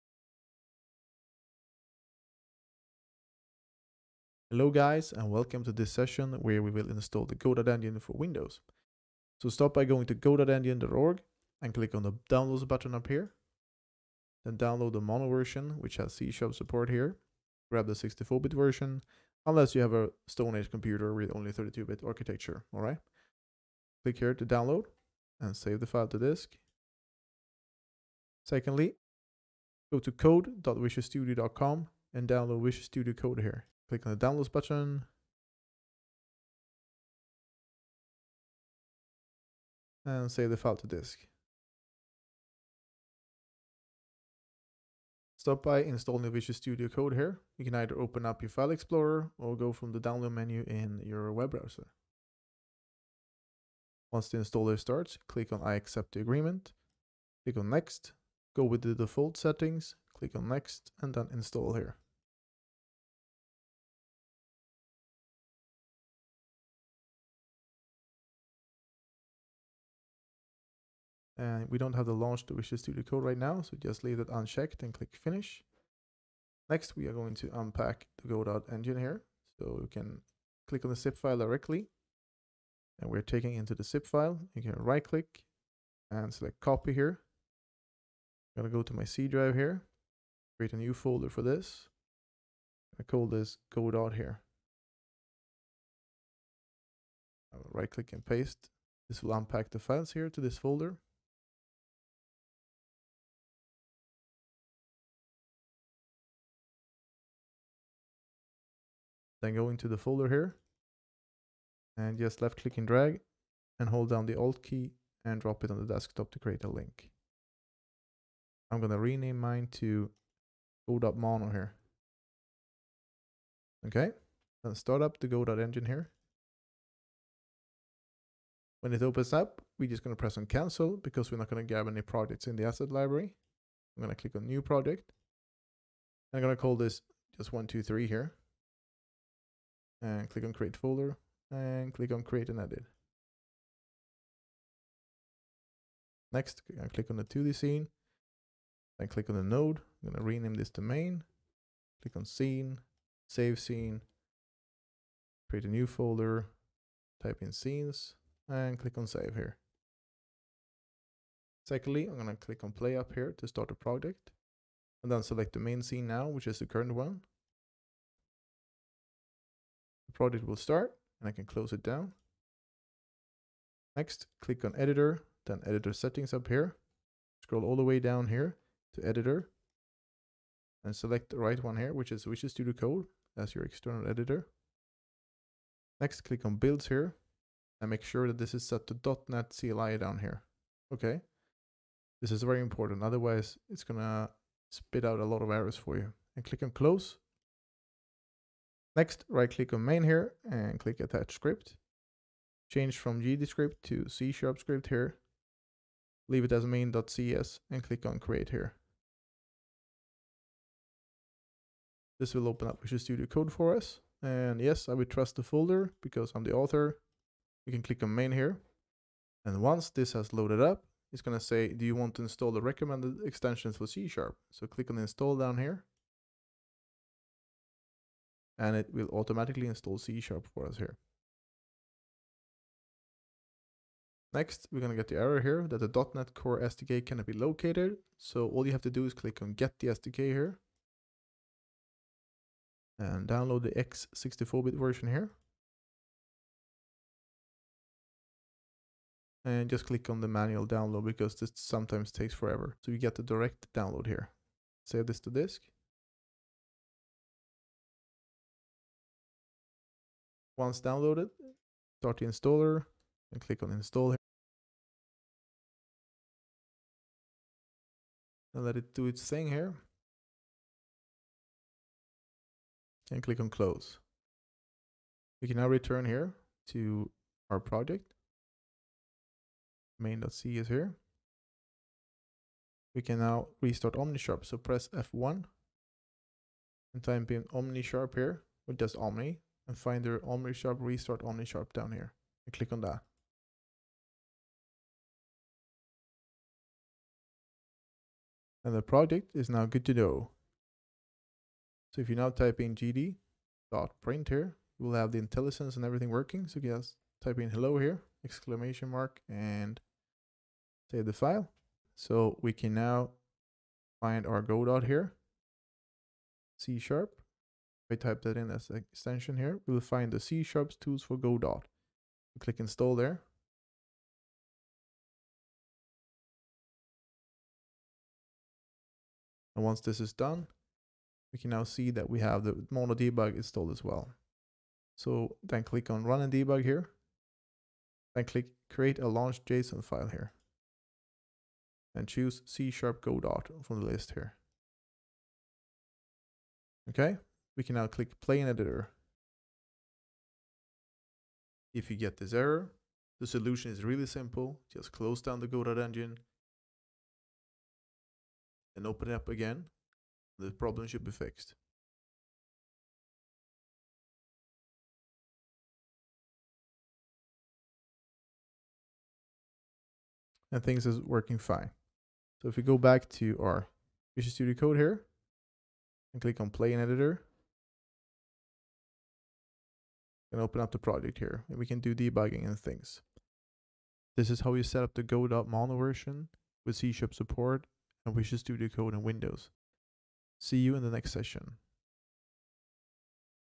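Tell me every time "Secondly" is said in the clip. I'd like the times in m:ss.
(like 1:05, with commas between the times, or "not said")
0:28, 2:41.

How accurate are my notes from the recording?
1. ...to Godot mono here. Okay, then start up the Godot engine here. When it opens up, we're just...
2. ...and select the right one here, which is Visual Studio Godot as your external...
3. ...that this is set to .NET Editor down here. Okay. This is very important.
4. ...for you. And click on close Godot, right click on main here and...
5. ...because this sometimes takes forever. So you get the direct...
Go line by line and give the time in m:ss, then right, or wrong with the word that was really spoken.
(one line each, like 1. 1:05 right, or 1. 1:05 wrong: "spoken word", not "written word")
1. 1:59 right
2. 3:00 wrong: "Code", not "Godot"
3. 3:08 wrong: "CLI", not "Editor"
4. 3:15 wrong: "Next", not "Godot"
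5. 4:11 right.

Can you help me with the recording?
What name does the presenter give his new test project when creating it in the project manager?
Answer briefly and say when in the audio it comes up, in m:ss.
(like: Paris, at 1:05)
one, two, three, at 2:17.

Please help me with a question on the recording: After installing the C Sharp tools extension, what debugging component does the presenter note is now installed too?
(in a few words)
Mono debug.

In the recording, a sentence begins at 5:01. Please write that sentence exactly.
So if you now type in gd dot printer, you will have the IntelliSense and everything working.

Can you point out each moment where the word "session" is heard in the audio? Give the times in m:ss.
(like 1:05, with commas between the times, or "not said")
0:05, 6:31.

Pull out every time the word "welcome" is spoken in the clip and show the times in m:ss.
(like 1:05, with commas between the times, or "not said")
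0:05.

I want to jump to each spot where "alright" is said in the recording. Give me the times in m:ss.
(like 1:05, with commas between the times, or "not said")
0:22.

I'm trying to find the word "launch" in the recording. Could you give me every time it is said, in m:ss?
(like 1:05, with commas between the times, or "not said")
1:12, 5:39.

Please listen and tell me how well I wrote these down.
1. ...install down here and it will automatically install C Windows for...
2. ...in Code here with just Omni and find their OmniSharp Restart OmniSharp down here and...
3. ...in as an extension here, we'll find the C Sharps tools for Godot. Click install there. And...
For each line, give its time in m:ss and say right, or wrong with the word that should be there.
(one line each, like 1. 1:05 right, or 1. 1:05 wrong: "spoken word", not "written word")
1. 3:44 wrong: "Sharp", not "Windows"
2. 4:47 wrong: "OmniSharp", not "Code"
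3. 5:18 right.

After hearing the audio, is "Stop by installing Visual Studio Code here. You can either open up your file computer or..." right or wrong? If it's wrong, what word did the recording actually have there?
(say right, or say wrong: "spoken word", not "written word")
wrong: "explorer", not "computer".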